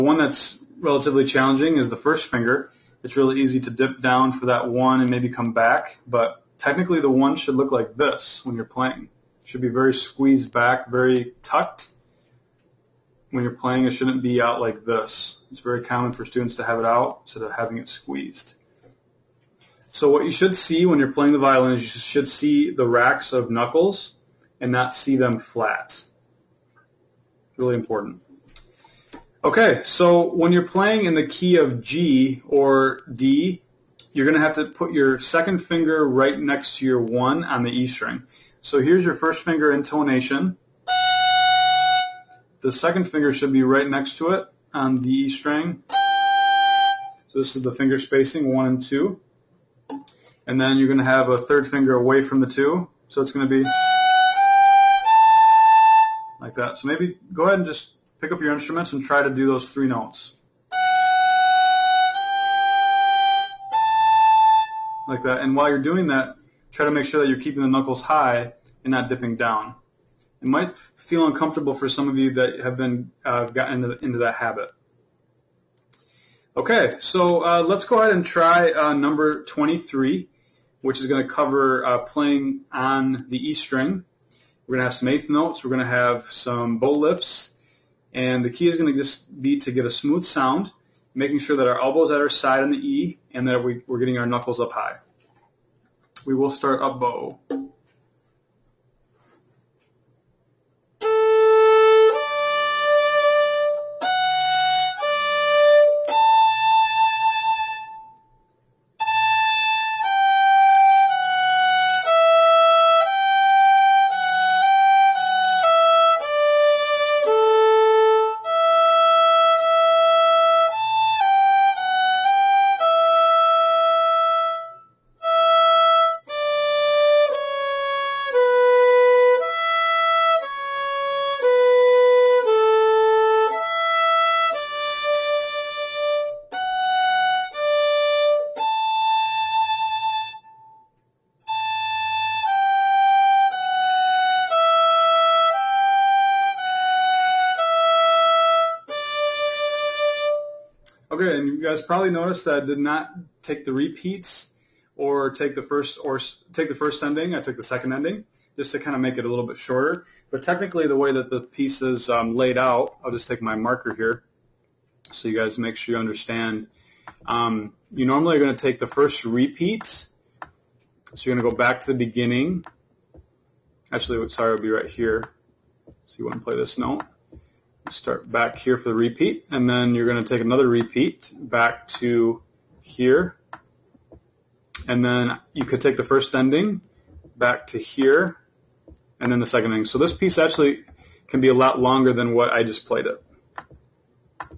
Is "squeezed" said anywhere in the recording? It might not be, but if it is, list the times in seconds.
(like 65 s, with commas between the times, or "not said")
9 s, 17 s.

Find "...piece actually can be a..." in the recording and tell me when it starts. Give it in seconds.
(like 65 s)
190 s.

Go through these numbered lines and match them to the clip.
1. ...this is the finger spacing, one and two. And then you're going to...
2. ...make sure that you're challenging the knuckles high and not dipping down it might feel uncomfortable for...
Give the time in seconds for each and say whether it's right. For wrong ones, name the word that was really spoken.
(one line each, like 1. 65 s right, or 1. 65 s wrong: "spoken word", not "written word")
1. 47 s right
2. 66 s wrong: "keeping", not "challenging".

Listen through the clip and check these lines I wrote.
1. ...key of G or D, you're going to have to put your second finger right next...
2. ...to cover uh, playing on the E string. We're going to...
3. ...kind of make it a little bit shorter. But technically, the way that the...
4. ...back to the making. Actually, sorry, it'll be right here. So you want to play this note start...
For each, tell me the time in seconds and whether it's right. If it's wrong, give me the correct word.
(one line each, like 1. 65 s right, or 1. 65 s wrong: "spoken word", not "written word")
1. 31 s right
2. 81 s right
3. 158 s right
4. 171 s wrong: "beginning", not "making".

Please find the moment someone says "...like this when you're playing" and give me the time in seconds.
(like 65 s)
7 s.